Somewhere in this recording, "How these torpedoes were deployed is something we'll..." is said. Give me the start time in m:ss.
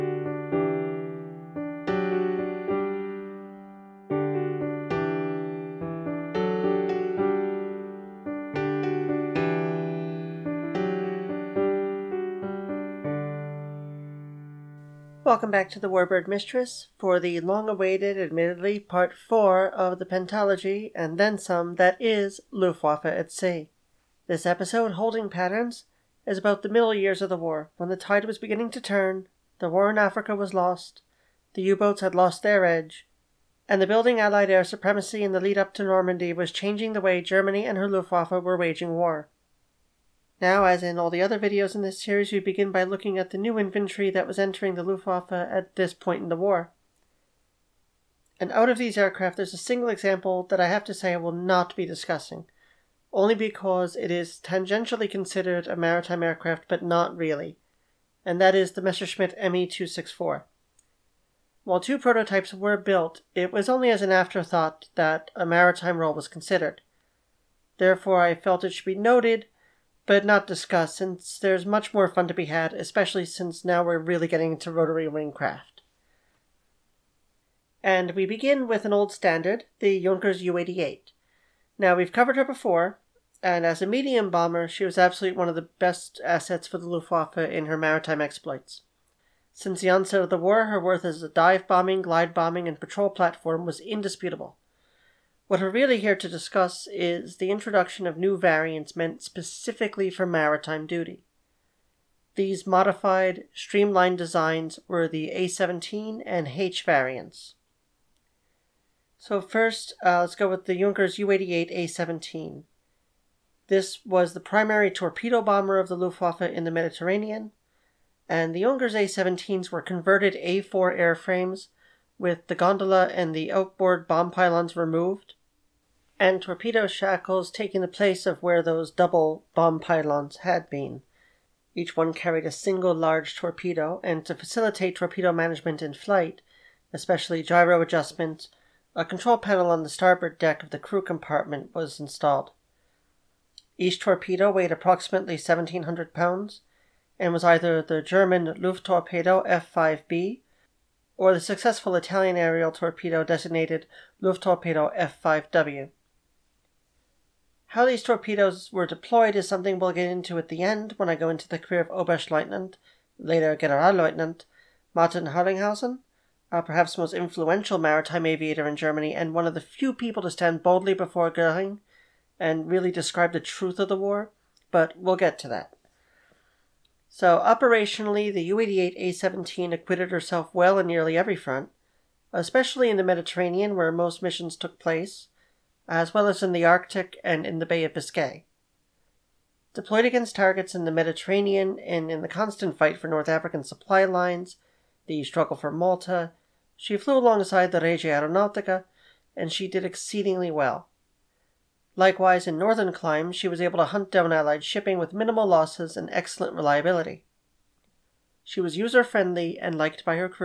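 2:37.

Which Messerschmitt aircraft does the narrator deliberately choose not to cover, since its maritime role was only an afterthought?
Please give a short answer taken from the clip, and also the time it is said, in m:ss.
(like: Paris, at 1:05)
ME 264, at 0:58.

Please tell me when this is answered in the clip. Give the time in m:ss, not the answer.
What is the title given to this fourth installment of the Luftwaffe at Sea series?
0:24.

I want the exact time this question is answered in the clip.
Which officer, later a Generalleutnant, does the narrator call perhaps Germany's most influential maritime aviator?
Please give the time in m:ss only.
2:44.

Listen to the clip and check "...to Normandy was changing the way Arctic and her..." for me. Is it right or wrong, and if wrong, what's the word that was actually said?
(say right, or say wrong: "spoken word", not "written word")
wrong: "Germany", not "Arctic".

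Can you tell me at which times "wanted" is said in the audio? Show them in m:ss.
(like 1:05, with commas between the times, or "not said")
not said.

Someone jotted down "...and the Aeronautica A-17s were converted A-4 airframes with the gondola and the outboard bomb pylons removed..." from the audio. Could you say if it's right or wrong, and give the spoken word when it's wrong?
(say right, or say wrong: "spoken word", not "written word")
wrong: "Junkers", not "Aeronautica".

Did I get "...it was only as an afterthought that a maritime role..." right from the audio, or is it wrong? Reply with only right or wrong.
right.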